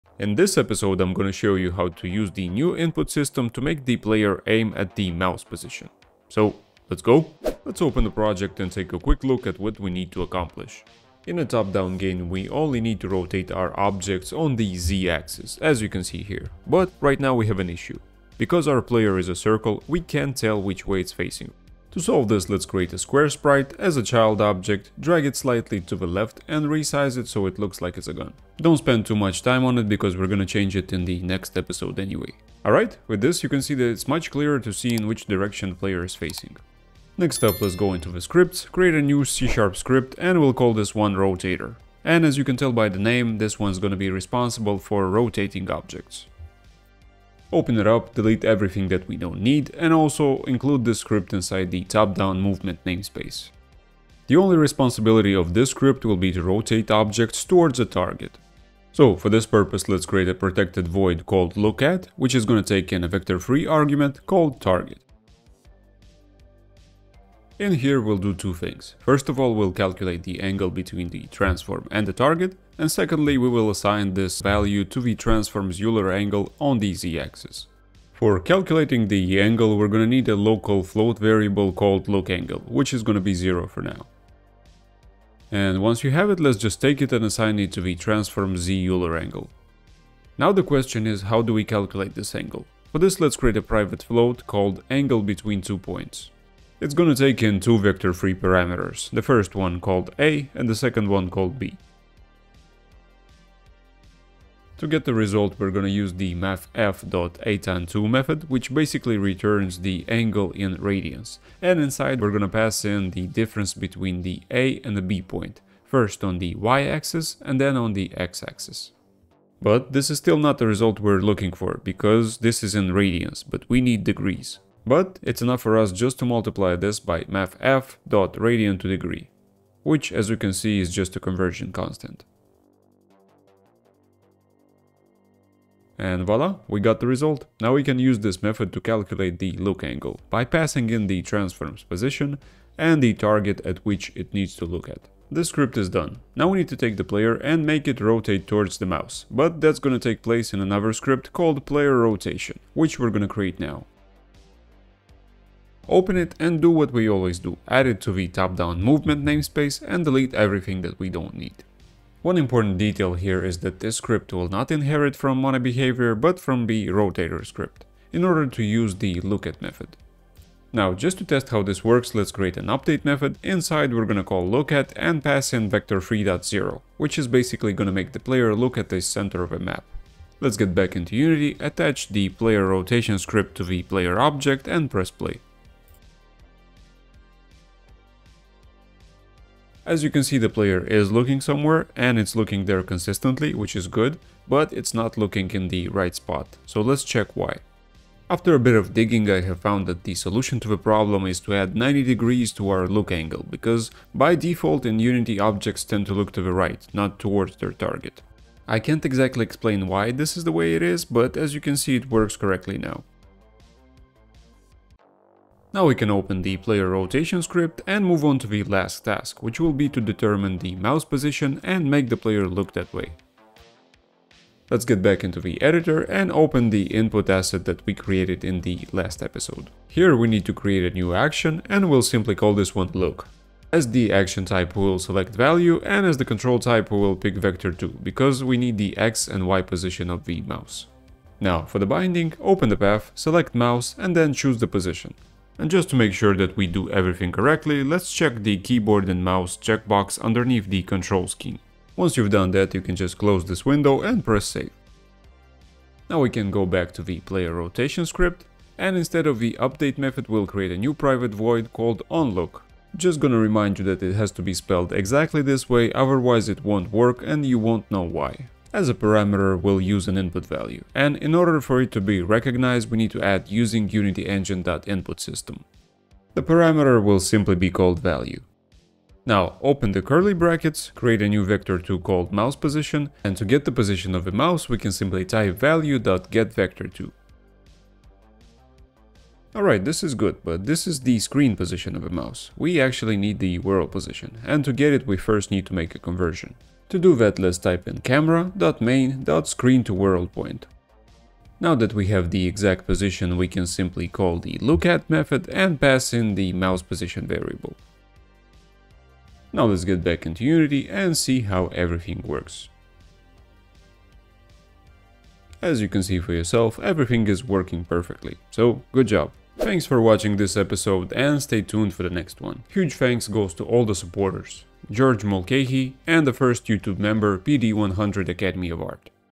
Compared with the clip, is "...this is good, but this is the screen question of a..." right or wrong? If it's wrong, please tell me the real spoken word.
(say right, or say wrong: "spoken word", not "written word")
wrong: "position", not "question".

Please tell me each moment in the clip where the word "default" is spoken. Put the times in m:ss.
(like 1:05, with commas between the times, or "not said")
3:24.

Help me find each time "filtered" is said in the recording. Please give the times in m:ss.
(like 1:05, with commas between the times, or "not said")
not said.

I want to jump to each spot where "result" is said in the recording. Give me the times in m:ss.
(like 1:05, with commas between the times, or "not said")
1:45, 2:00, 2:17.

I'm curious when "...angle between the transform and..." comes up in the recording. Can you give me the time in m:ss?
1:10.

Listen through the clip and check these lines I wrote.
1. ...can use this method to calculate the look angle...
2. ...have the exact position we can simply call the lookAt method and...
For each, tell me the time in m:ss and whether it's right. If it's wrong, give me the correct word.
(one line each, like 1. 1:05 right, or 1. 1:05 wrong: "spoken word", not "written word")
1. 2:17 right
2. 5:02 right.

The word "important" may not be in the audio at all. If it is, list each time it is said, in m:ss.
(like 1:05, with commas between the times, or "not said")
2:42.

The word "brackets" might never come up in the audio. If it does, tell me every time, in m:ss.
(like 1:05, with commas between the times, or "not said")
4:40.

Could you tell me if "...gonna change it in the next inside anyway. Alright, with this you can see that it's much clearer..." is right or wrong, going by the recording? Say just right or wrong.
wrong.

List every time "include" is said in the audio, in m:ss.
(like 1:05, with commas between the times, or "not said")
0:50.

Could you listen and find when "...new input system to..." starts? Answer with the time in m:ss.
0:02.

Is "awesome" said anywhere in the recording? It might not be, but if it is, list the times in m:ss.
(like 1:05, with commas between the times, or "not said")
not said.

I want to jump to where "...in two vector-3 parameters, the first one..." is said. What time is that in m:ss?
1:37.